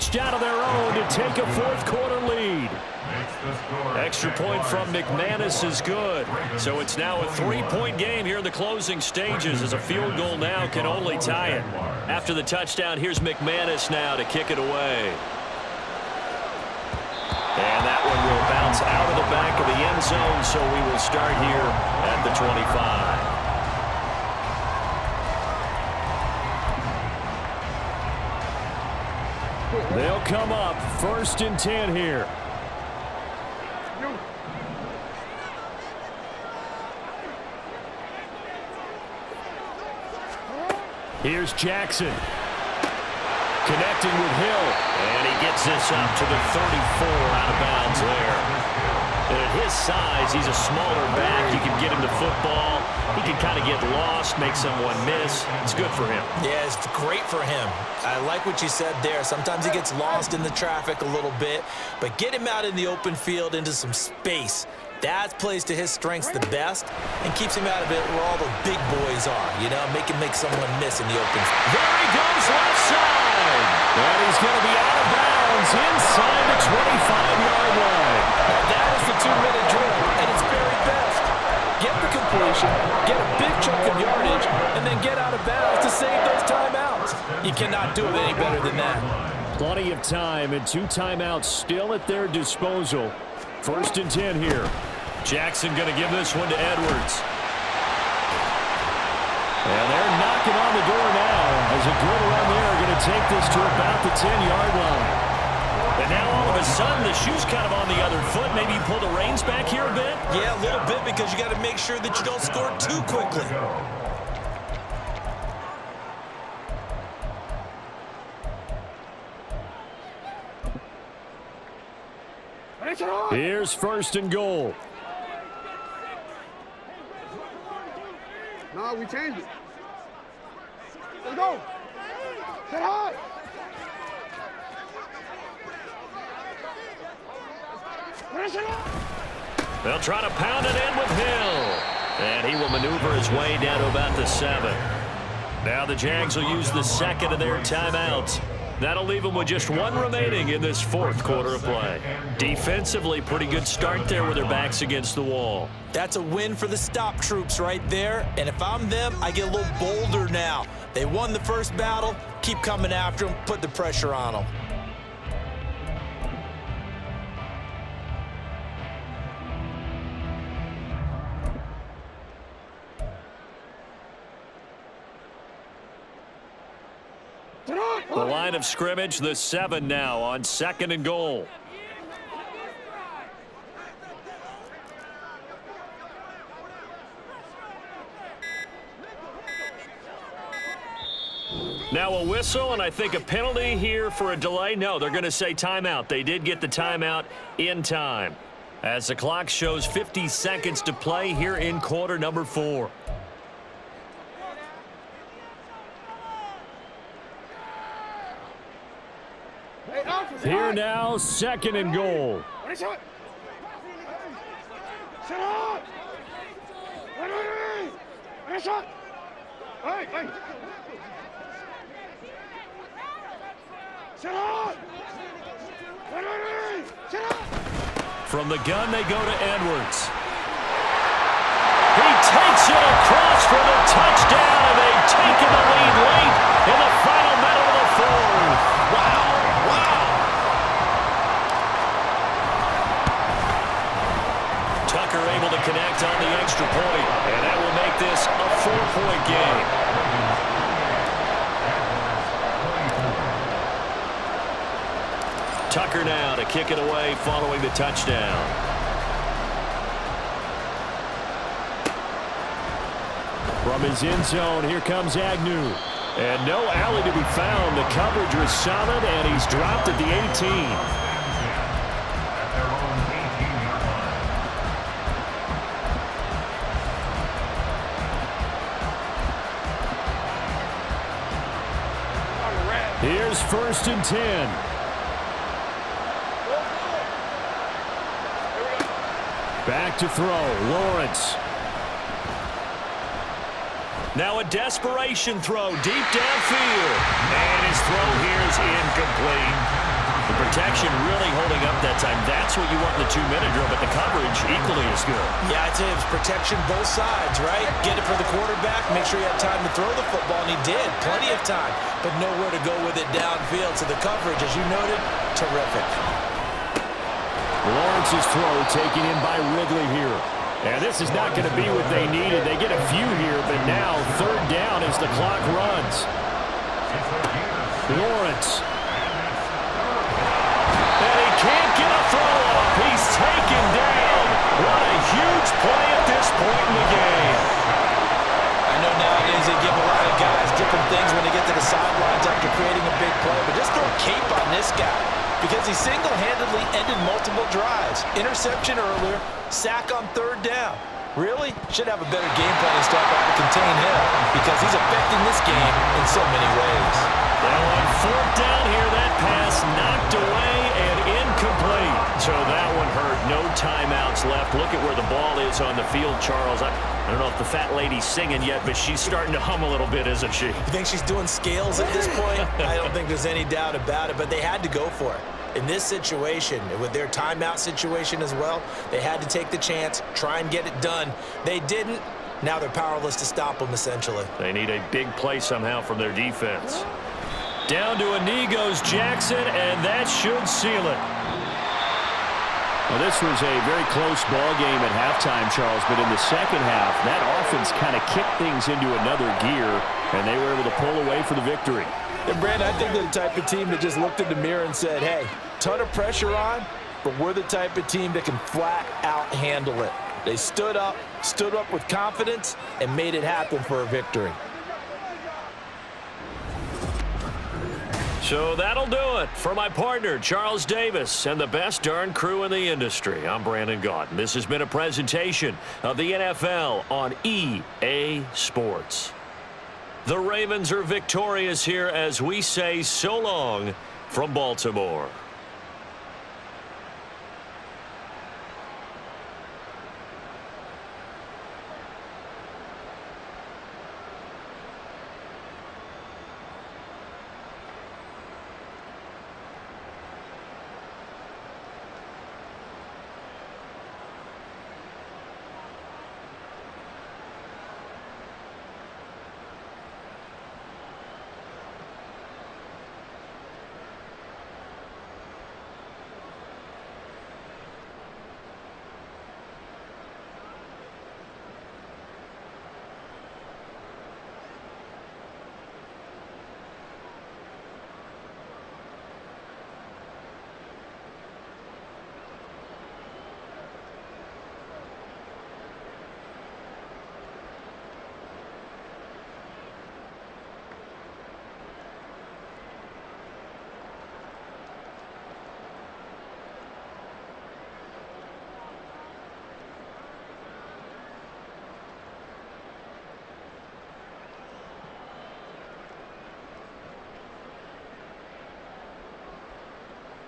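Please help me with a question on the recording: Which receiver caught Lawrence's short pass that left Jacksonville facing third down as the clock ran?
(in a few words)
Ridley.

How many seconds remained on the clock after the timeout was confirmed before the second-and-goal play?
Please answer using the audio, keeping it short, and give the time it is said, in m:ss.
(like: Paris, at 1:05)
50, at 3:19.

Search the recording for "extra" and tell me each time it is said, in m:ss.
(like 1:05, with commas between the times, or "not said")
0:03, 4:06.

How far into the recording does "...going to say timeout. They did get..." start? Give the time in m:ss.
3:15.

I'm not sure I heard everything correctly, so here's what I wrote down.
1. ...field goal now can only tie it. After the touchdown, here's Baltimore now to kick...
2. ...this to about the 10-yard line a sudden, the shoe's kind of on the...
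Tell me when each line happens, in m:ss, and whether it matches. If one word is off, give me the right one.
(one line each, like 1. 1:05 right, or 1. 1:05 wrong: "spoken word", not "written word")
1. 0:09 wrong: "McManus", not "Baltimore"
2. 1:43 right.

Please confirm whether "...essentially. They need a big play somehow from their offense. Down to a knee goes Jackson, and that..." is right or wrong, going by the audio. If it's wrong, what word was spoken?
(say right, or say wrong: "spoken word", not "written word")
wrong: "defense", not "offense".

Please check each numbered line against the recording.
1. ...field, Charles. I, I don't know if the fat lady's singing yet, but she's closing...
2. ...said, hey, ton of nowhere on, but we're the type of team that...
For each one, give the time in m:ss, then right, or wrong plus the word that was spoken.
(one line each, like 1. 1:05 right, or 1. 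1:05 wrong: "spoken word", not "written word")
1. 6:05 wrong: "starting", not "closing"
2. 6:44 wrong: "pressure", not "nowhere".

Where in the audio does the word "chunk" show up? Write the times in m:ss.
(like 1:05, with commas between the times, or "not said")
1:23.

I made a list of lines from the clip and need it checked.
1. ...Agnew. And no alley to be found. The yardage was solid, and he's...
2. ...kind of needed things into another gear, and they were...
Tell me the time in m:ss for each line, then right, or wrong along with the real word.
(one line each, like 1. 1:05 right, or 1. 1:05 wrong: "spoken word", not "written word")
1. 4:25 wrong: "coverage", not "yardage"
2. 6:37 wrong: "kicked", not "needed".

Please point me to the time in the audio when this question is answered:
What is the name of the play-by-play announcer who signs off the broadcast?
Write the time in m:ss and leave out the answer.
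7:03.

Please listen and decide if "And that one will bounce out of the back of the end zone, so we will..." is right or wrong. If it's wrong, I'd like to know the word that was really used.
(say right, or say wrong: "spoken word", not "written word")
right.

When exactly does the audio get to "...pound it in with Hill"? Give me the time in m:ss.
2:20.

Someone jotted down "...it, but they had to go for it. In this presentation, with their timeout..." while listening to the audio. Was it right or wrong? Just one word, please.
wrong.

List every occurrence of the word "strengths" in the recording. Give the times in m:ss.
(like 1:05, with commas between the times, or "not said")
1:05.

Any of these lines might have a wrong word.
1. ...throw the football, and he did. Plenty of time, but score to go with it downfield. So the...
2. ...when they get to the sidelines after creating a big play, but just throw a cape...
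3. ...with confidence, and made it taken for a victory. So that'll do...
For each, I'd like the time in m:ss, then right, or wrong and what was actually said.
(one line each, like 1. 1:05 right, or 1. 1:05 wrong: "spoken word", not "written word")
1. 5:09 wrong: "nowhere", not "score"
2. 5:41 right
3. 6:51 wrong: "happen", not "taken".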